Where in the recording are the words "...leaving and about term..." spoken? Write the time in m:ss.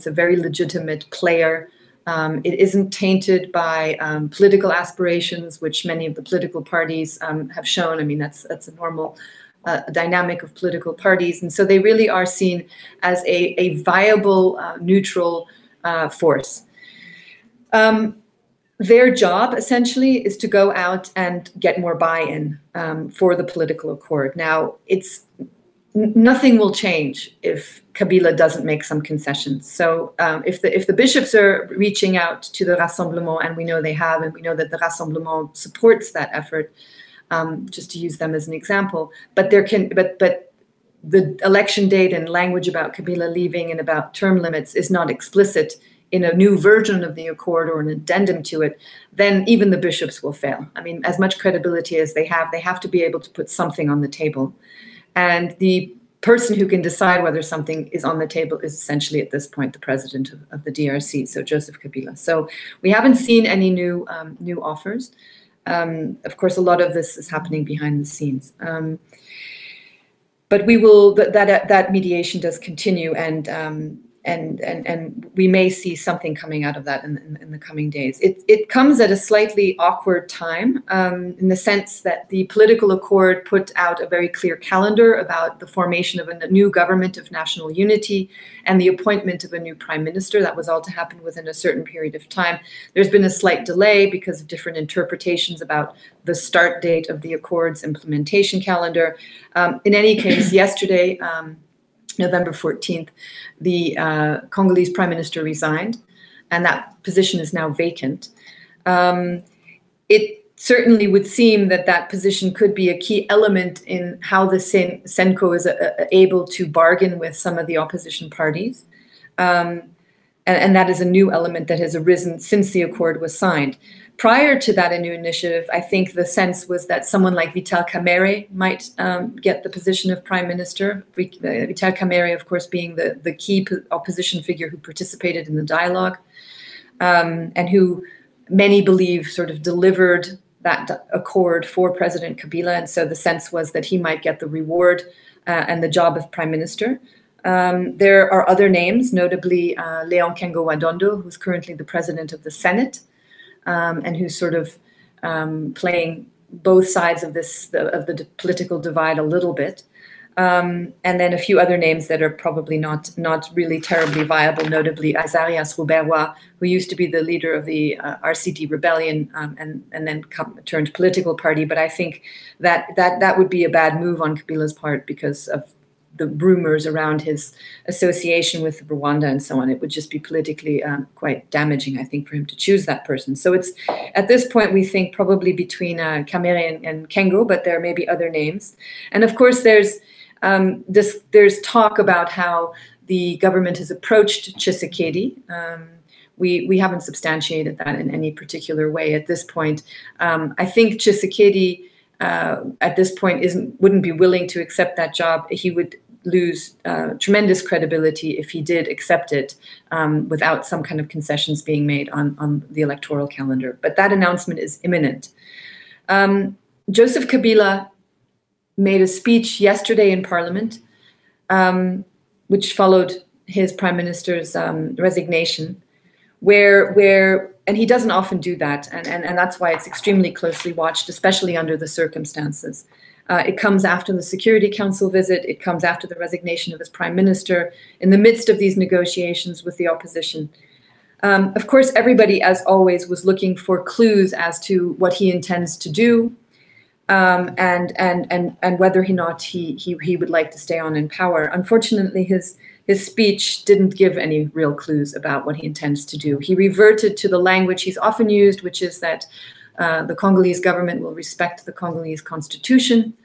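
0:43.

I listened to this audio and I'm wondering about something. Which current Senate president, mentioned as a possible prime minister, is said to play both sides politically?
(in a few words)
Leon Kengo wa Dondo.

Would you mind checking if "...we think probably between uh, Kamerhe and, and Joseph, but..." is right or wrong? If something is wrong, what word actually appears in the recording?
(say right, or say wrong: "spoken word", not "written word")
wrong: "Kengo", not "Joseph".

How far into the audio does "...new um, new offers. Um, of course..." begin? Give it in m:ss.
1:03.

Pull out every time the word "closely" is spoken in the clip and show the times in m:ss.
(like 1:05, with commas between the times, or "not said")
3:50.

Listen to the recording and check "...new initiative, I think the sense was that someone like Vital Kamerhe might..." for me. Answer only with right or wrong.
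right.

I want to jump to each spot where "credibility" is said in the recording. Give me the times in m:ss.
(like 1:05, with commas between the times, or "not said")
0:51, 3:27.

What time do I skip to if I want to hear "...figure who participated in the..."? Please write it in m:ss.
2:14.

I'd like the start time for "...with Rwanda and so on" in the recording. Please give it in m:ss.
2:58.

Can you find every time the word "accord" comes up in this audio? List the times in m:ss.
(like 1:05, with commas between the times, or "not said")
0:23, 0:47, 1:22, 1:37, 2:02, 2:21.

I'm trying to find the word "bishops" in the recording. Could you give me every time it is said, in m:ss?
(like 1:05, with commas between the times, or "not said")
0:30, 0:49.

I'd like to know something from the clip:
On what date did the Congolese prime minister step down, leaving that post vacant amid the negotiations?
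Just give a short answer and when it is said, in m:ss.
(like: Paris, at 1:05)
November 14th, at 1:42.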